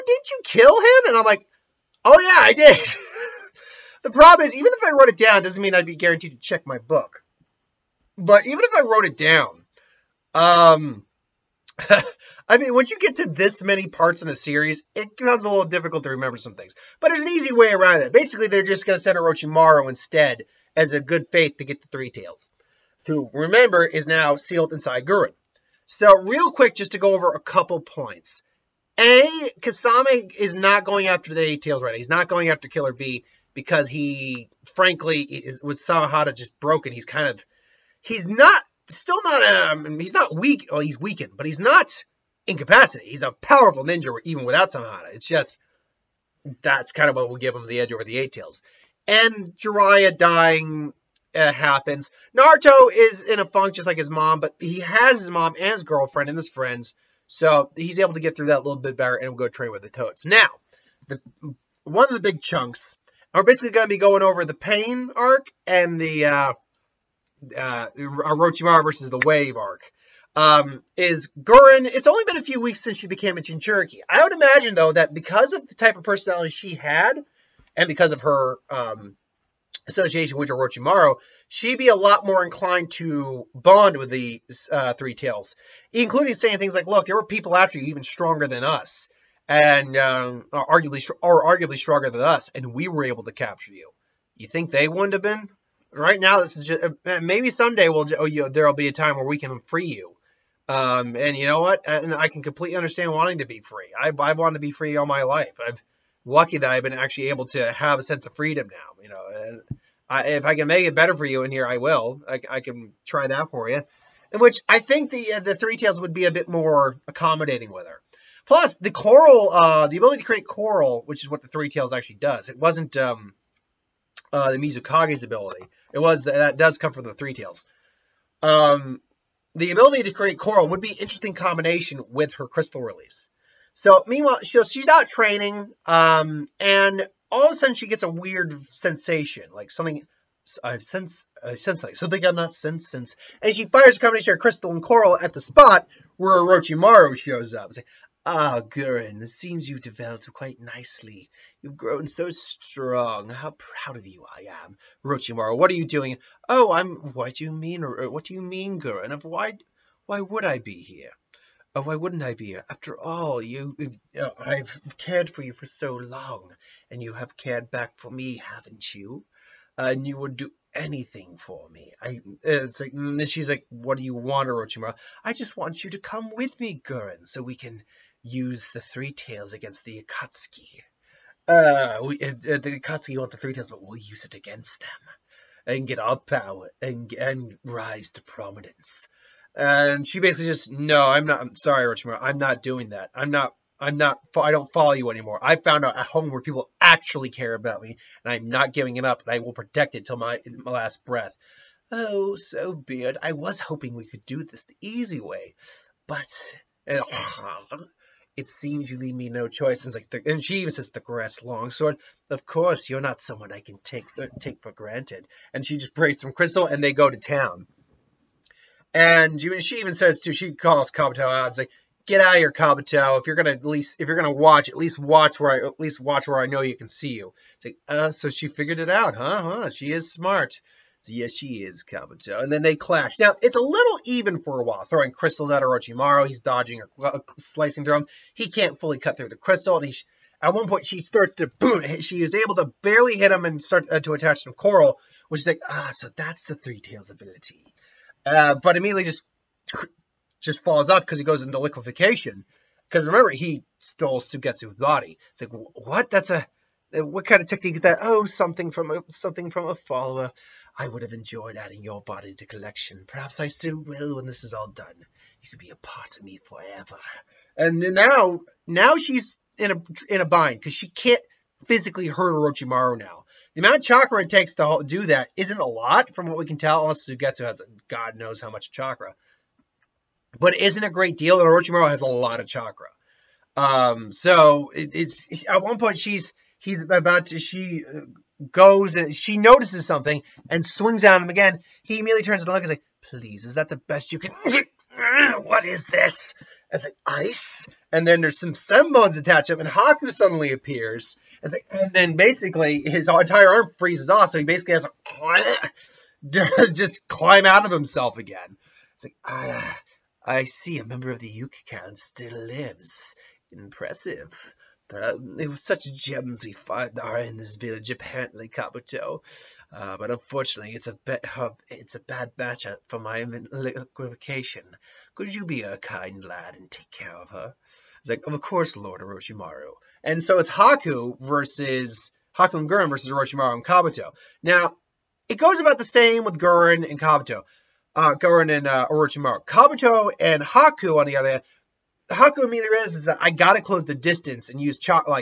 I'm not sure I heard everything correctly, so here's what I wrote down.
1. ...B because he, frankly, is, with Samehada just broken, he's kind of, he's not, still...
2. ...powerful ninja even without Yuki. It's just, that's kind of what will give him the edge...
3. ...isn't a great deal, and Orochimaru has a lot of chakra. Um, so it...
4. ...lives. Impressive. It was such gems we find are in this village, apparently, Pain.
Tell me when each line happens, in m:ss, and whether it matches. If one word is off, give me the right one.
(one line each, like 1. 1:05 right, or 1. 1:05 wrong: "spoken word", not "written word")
1. 0:32 right
2. 0:43 wrong: "Samehada", not "Yuki"
3. 4:40 right
4. 5:12 wrong: "Kabuto", not "Pain".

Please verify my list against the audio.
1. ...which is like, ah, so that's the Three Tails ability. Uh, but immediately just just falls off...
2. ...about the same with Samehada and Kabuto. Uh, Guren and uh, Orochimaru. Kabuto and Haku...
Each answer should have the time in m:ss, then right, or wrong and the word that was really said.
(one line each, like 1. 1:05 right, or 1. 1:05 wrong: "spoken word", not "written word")
1. 4:05 right
2. 5:35 wrong: "Guren", not "Samehada".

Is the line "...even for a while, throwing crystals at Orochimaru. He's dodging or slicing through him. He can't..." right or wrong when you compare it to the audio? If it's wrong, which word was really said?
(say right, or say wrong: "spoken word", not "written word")
right.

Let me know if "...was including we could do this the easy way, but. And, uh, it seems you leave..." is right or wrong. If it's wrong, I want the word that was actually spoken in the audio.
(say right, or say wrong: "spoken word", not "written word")
wrong: "hoping", not "including".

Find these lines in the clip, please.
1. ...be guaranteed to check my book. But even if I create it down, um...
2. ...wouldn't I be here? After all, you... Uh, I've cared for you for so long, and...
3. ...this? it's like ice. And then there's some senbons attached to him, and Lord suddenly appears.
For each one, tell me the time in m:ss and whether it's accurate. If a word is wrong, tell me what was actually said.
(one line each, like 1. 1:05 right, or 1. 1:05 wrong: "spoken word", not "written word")
1. 0:05 wrong: "wrote", not "create"
2. 2:41 right
3. 4:55 wrong: "Haku", not "Lord".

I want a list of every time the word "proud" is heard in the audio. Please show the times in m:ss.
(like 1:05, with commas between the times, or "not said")
2:33.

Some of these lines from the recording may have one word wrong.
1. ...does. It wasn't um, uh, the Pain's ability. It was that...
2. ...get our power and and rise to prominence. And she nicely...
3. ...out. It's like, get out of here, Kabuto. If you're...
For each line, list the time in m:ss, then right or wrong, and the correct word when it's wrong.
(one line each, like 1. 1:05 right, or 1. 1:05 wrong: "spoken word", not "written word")
1. 2:02 wrong: "Mizukage", not "Pain"
2. 3:05 wrong: "basically", not "nicely"
3. 3:41 right.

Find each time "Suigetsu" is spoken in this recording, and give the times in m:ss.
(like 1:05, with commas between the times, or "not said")
4:14, 4:37.